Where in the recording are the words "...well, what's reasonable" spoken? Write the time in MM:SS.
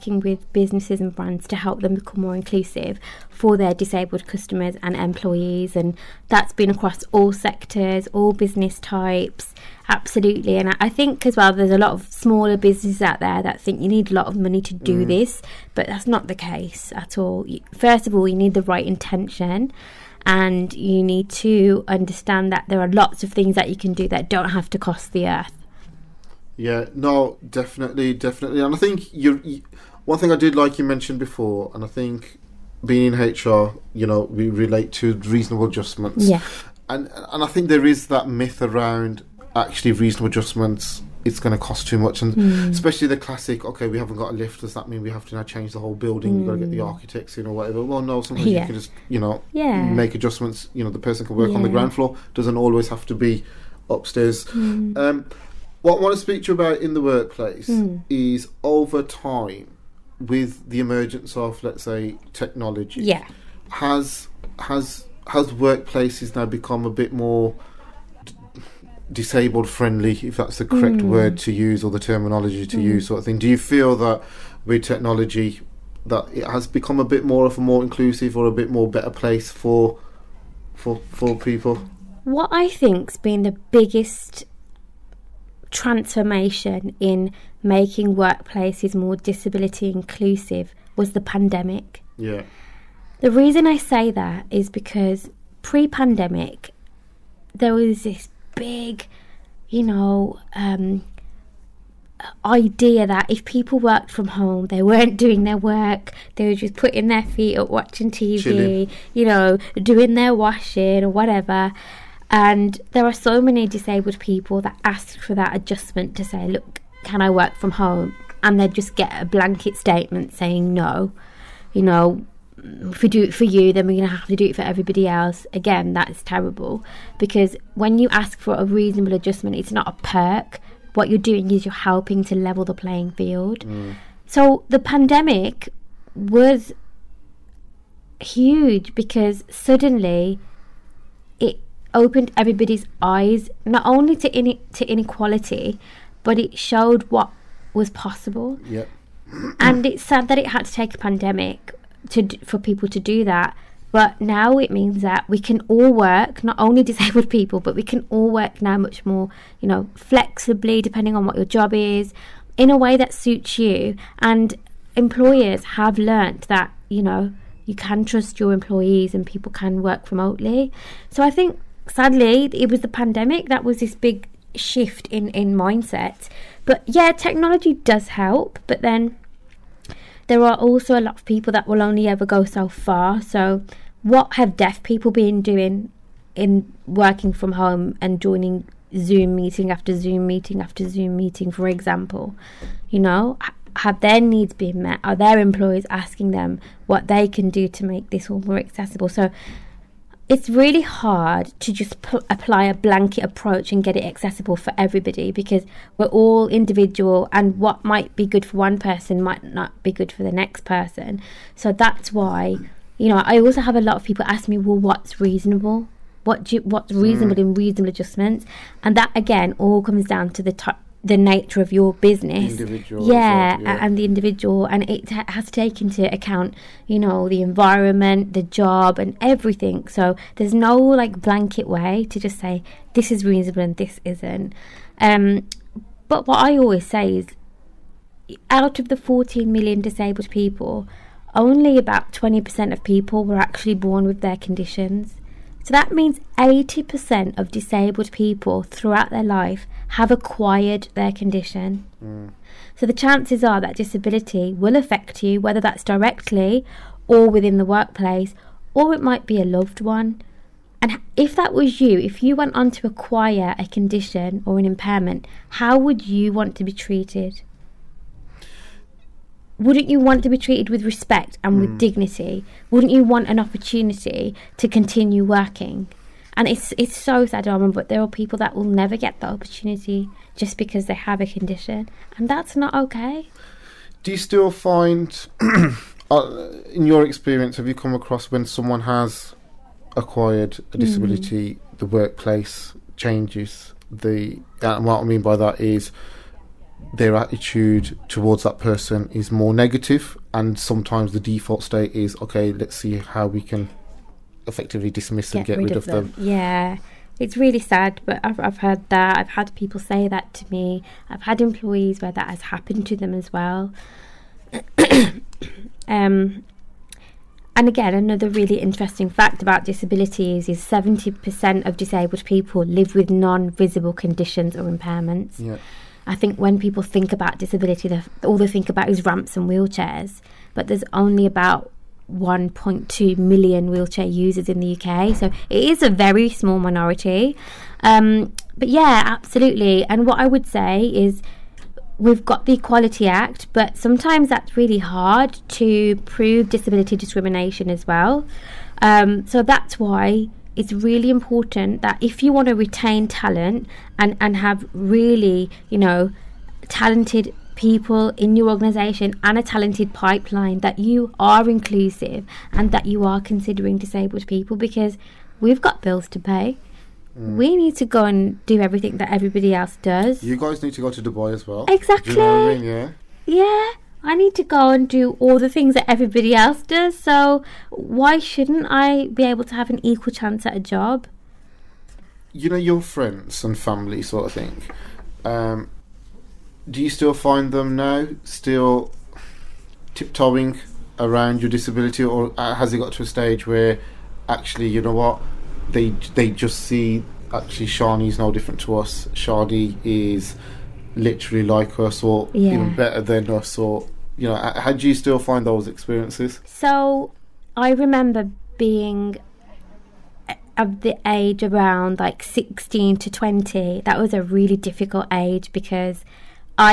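03:34.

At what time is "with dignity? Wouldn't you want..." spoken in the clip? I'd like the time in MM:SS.
04:31.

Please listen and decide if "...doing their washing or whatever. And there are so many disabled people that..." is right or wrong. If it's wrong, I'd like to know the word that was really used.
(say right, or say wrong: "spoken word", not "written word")
right.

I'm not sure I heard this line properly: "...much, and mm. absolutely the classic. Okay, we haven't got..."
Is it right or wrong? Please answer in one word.
wrong.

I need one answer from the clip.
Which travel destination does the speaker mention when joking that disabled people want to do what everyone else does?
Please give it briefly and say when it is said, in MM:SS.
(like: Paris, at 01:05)
Dubai, at 06:11.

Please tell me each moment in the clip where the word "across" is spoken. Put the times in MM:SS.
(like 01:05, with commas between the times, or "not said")
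00:06, 04:47.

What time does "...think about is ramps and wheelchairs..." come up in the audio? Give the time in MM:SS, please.
05:28.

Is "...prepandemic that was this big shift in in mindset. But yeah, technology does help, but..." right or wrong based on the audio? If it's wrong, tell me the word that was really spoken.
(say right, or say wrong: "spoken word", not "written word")
wrong: "pandemic", not "prepandemic".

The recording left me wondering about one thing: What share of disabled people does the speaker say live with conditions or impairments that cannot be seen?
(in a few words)
70%.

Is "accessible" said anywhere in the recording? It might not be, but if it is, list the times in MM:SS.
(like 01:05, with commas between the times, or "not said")
03:18, 03:24.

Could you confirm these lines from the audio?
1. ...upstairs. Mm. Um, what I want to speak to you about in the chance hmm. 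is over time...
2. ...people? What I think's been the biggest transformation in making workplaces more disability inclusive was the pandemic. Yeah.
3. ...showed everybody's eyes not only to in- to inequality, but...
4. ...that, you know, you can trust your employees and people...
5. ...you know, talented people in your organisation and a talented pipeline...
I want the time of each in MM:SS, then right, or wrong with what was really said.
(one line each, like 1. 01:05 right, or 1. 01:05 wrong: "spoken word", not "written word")
1. 00:53 wrong: "workplace", not "chance"
2. 01:21 right
3. 02:21 wrong: "opened", not "showed"
4. 02:46 right
5. 05:55 right.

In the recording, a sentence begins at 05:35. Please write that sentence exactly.
So it is a very small minority.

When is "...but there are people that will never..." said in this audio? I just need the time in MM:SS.
04:37.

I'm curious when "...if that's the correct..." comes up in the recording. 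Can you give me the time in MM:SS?
01:10.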